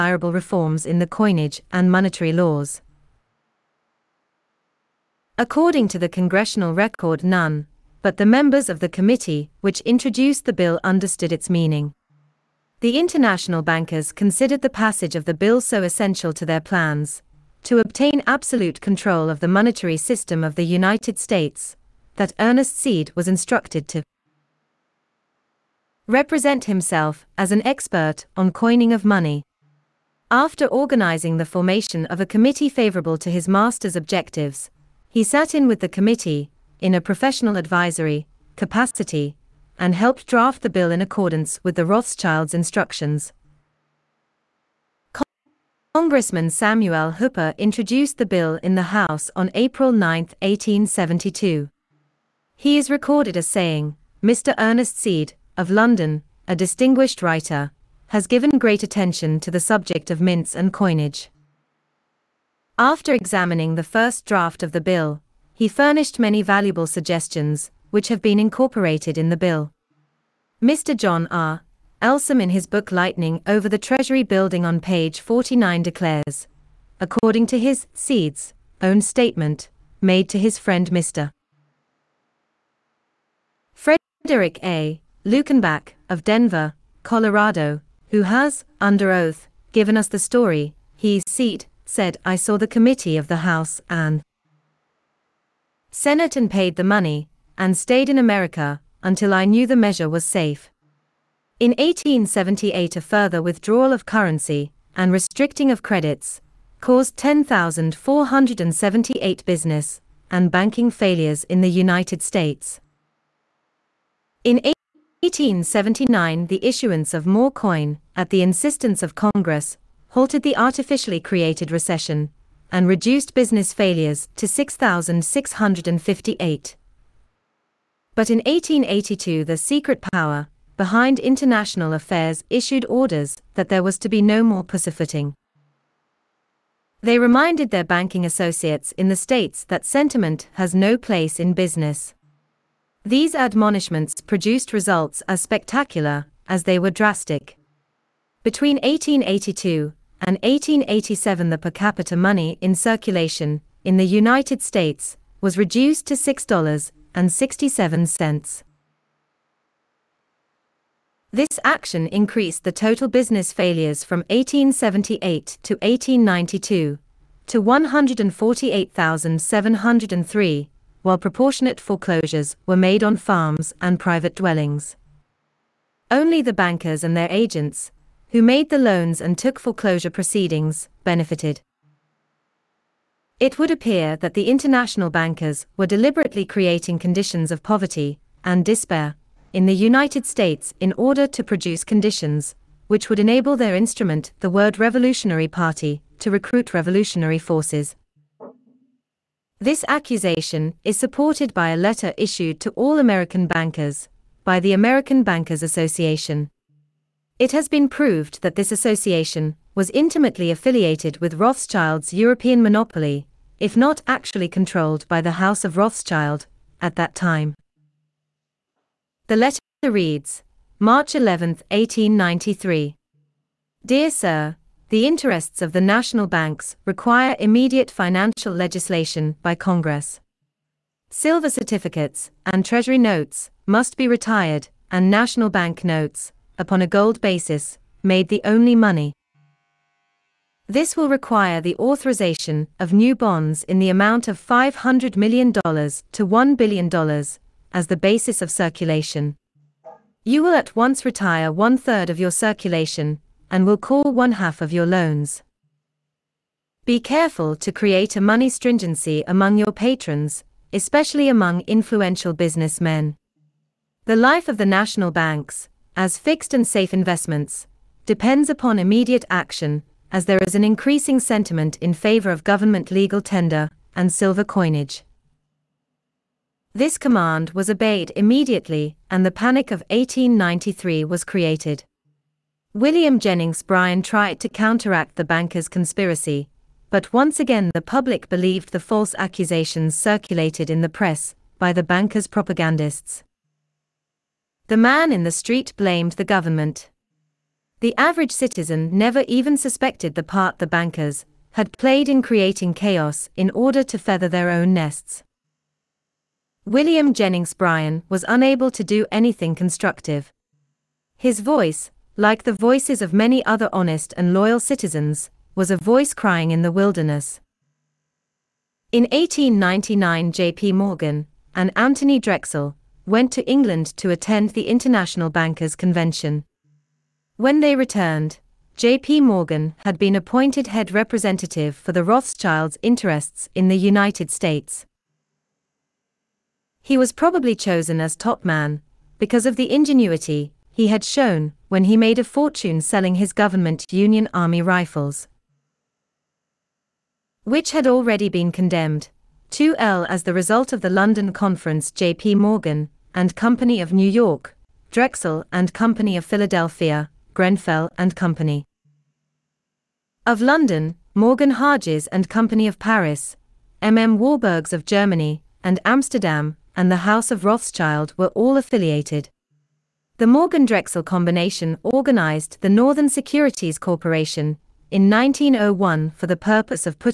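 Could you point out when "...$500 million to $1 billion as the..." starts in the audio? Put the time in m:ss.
4:04.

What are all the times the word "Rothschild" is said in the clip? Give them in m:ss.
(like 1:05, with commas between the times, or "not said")
0:41, 3:31, 3:35, 5:32, 6:07.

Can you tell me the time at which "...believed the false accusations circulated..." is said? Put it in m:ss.
4:48.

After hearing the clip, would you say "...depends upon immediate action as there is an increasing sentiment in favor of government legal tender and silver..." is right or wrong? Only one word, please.
right.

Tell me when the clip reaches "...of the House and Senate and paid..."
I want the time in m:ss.
1:33.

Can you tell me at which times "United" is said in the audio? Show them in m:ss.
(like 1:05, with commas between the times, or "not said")
0:20, 1:51, 2:34, 3:09, 5:33.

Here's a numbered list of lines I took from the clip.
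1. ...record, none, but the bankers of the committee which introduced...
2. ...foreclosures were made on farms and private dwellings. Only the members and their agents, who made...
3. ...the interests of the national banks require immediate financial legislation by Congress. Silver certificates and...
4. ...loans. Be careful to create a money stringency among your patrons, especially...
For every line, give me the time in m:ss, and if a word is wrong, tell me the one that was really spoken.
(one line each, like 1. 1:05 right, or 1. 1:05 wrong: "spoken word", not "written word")
1. 0:06 wrong: "members", not "bankers"
2. 2:51 wrong: "bankers", not "members"
3. 3:44 right
4. 4:14 right.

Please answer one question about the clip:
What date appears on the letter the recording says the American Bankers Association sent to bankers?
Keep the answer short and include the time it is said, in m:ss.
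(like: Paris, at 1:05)
March 11, 1893, at 3:40.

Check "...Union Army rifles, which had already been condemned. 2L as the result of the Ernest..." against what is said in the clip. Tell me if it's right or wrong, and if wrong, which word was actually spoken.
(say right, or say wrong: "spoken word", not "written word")
wrong: "London", not "Ernest".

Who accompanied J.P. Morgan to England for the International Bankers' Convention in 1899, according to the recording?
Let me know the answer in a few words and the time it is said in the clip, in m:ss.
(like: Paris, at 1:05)
Anthony Drexel, at 5:21.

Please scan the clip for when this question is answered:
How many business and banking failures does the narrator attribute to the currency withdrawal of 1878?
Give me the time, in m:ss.
1:47.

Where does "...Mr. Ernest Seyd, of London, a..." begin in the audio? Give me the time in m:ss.
0:54.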